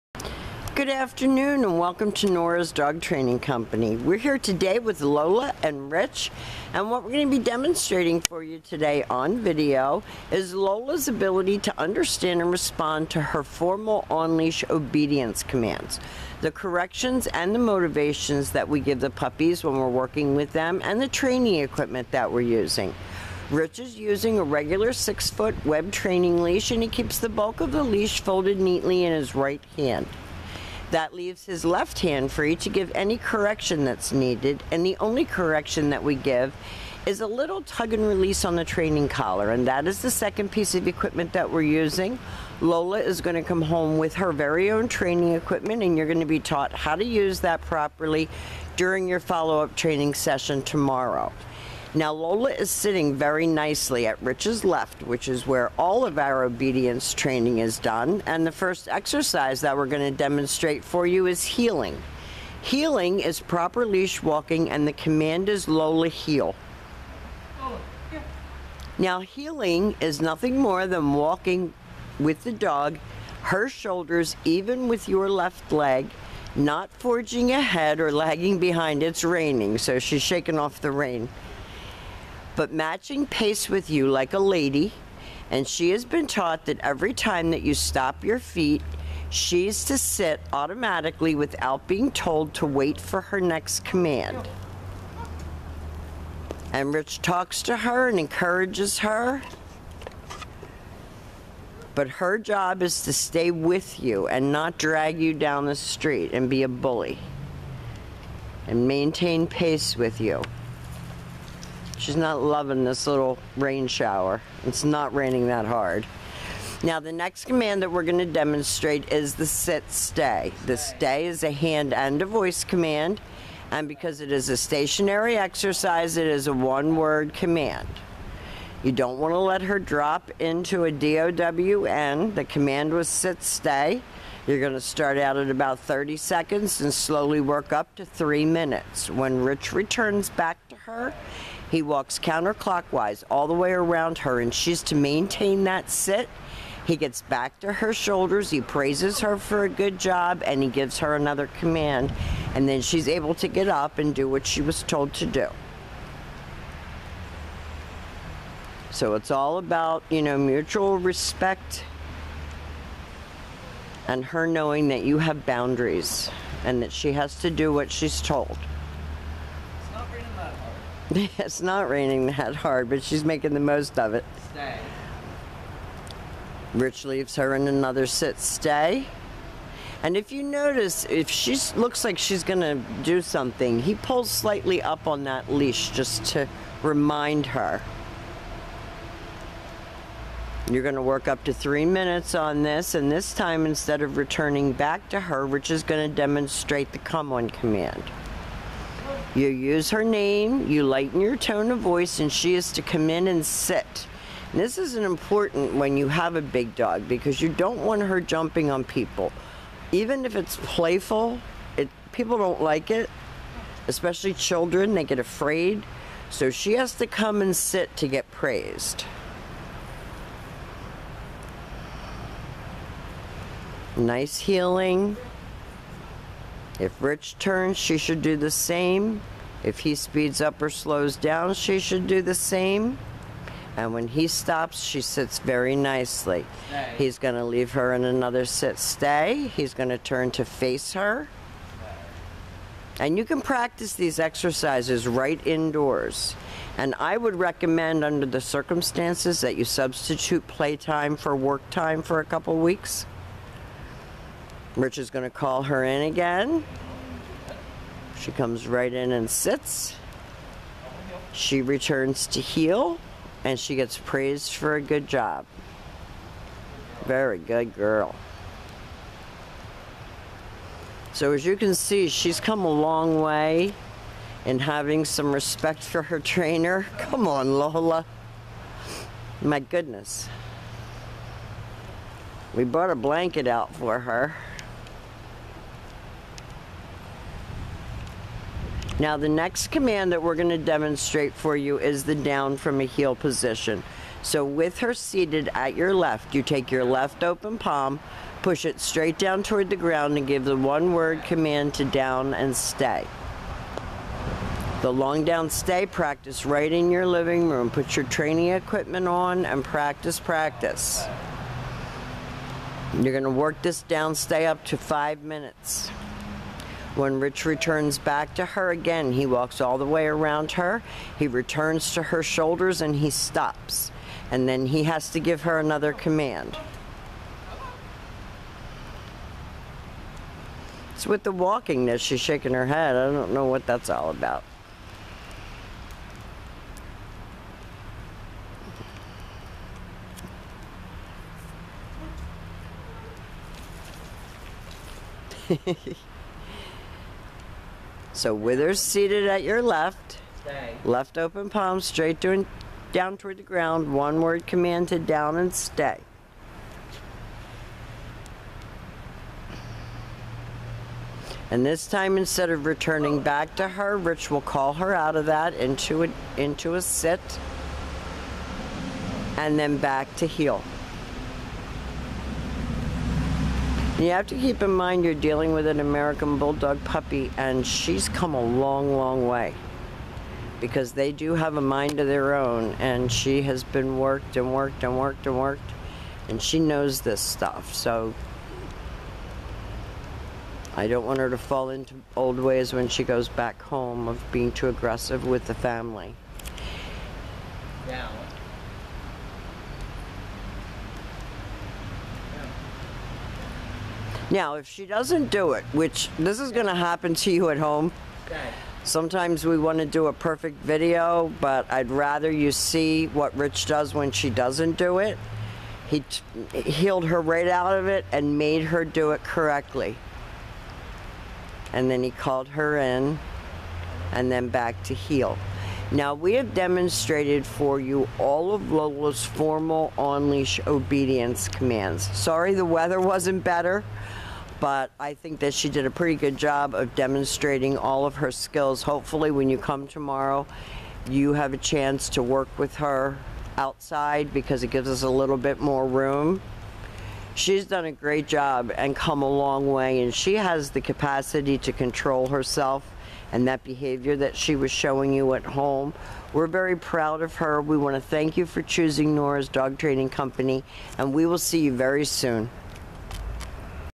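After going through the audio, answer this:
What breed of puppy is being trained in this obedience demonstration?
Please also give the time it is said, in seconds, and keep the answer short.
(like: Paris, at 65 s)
American Bulldog, at 375 s.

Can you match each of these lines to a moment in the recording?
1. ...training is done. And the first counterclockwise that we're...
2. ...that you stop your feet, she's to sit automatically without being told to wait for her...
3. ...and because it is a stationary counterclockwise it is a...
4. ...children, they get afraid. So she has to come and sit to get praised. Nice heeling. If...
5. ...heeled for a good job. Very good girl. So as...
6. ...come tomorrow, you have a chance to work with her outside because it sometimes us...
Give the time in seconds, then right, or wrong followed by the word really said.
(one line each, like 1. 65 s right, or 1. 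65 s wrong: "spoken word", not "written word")
1. 57 s wrong: "exercise", not "counterclockwise"
2. 87 s right
3. 123 s wrong: "exercise", not "counterclockwise"
4. 214 s right
5. 263 s wrong: "praised", not "heeled"
6. 439 s wrong: "gives", not "sometimes".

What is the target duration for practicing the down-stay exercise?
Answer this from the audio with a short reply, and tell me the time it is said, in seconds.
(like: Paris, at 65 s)
5 minutes, at 314 s.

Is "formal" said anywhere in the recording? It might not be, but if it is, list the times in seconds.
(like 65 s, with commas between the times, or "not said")
13 s, 429 s.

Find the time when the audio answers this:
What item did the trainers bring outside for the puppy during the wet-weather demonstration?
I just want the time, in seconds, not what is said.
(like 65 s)
282 s.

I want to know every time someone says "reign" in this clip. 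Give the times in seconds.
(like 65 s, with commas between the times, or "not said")
not said.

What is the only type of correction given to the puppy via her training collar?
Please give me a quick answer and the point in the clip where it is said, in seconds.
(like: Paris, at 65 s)
tug and release, at 37 s.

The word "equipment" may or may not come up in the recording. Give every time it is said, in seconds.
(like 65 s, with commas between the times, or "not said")
21 s, 40 s, 45 s, 308 s.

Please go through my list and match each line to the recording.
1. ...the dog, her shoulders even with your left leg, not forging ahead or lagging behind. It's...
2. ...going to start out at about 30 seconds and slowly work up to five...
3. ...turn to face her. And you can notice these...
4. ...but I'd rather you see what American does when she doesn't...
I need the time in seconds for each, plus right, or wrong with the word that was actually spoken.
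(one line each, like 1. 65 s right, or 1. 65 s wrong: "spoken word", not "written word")
1. 72 s right
2. 134 s wrong: "three", not "five"
3. 239 s wrong: "practice", not "notice"
4. 411 s wrong: "Rich", not "American".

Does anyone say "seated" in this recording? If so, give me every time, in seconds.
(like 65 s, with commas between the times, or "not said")
294 s, 348 s.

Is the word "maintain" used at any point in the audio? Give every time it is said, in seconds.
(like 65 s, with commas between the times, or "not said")
108 s, 144 s.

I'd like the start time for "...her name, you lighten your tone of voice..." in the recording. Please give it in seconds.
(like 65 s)
199 s.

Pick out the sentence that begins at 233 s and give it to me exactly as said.
And when he stops, she sits very nicely.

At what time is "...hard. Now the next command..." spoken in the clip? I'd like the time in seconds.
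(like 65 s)
115 s.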